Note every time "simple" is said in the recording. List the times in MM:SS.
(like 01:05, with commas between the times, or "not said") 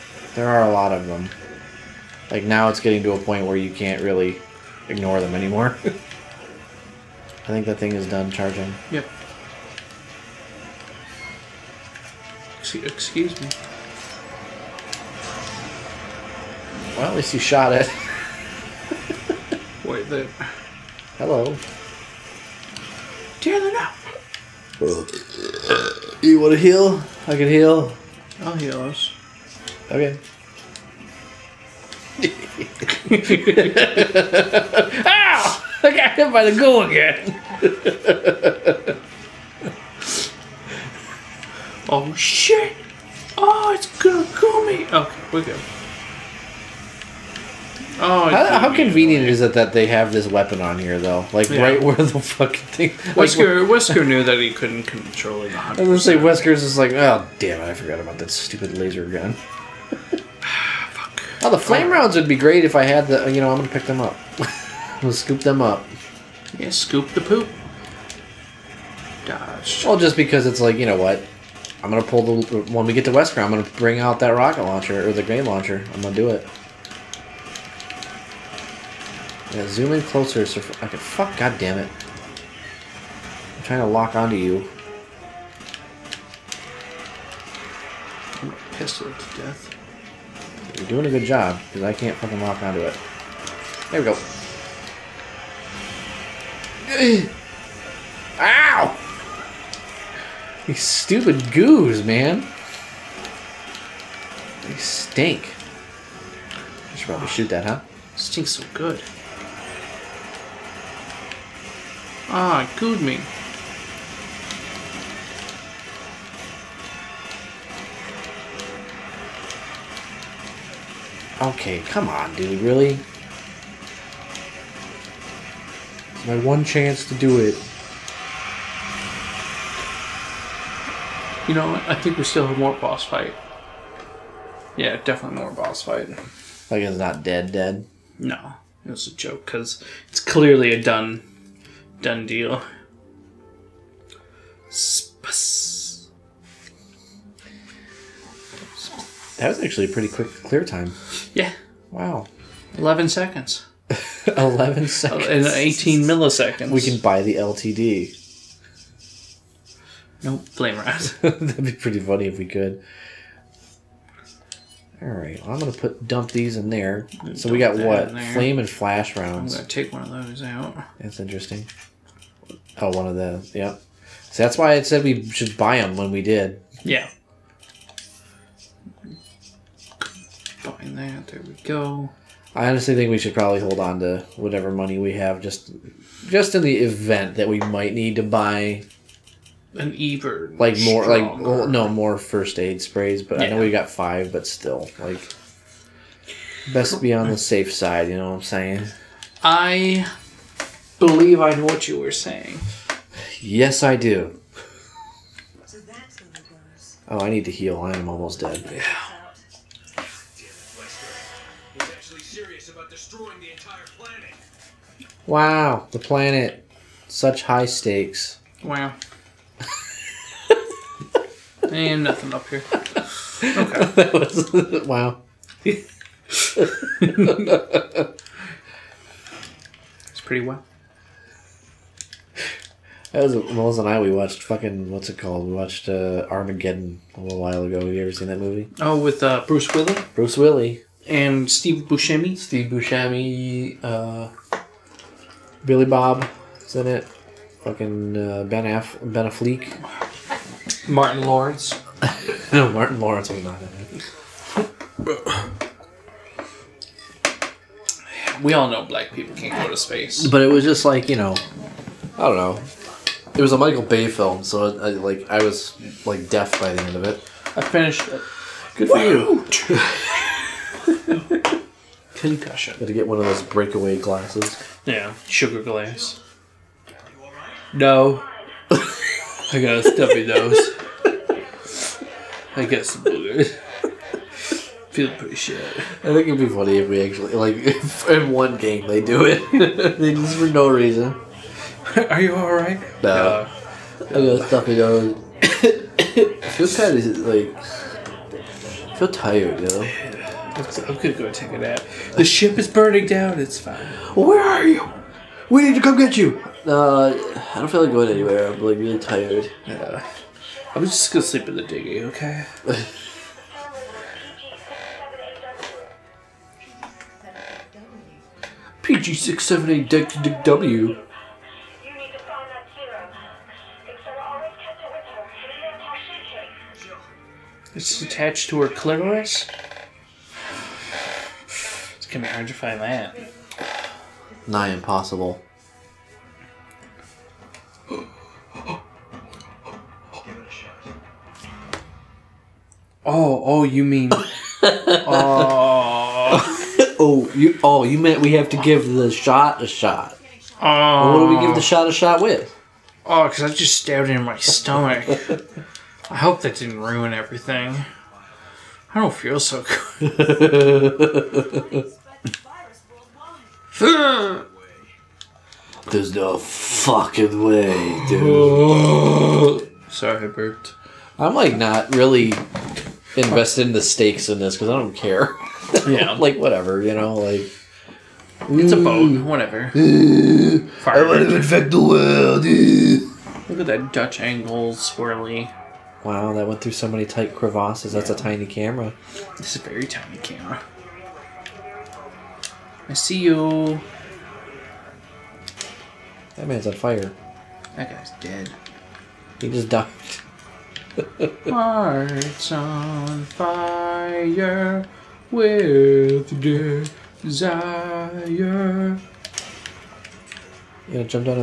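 not said.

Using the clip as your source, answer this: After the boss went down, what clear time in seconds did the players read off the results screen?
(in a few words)
11 seconds.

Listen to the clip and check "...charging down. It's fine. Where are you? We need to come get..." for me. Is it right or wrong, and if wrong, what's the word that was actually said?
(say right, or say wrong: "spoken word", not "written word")
wrong: "burning", not "charging".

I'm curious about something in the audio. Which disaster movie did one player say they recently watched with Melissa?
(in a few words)
Armageddon.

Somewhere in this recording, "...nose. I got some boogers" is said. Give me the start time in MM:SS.
04:40.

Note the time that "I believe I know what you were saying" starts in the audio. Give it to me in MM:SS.
03:19.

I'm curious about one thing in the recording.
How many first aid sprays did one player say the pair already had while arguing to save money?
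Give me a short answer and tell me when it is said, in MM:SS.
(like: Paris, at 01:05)
5, at 03:13.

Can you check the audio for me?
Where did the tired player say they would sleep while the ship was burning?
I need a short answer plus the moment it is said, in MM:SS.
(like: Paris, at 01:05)
In the dinghy, at 05:11.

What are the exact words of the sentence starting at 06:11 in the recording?
I'm like not really invested in the stakes in this because I don't care.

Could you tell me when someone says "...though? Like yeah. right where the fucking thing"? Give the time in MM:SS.
00:50.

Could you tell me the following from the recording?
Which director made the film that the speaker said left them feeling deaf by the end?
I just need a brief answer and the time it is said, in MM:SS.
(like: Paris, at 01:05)
Michael Bay, at 04:23.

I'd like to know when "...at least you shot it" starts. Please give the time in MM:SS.
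00:17.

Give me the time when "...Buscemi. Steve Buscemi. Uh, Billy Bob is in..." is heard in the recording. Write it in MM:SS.
04:01.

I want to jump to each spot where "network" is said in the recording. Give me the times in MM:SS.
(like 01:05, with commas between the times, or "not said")
not said.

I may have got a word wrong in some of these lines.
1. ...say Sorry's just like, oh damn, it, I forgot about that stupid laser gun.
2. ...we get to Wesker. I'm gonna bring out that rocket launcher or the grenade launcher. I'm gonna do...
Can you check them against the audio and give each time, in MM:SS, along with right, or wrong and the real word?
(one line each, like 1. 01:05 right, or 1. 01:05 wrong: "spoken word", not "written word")
1. 00:55 wrong: "Wesker", not "Sorry"
2. 01:12 right.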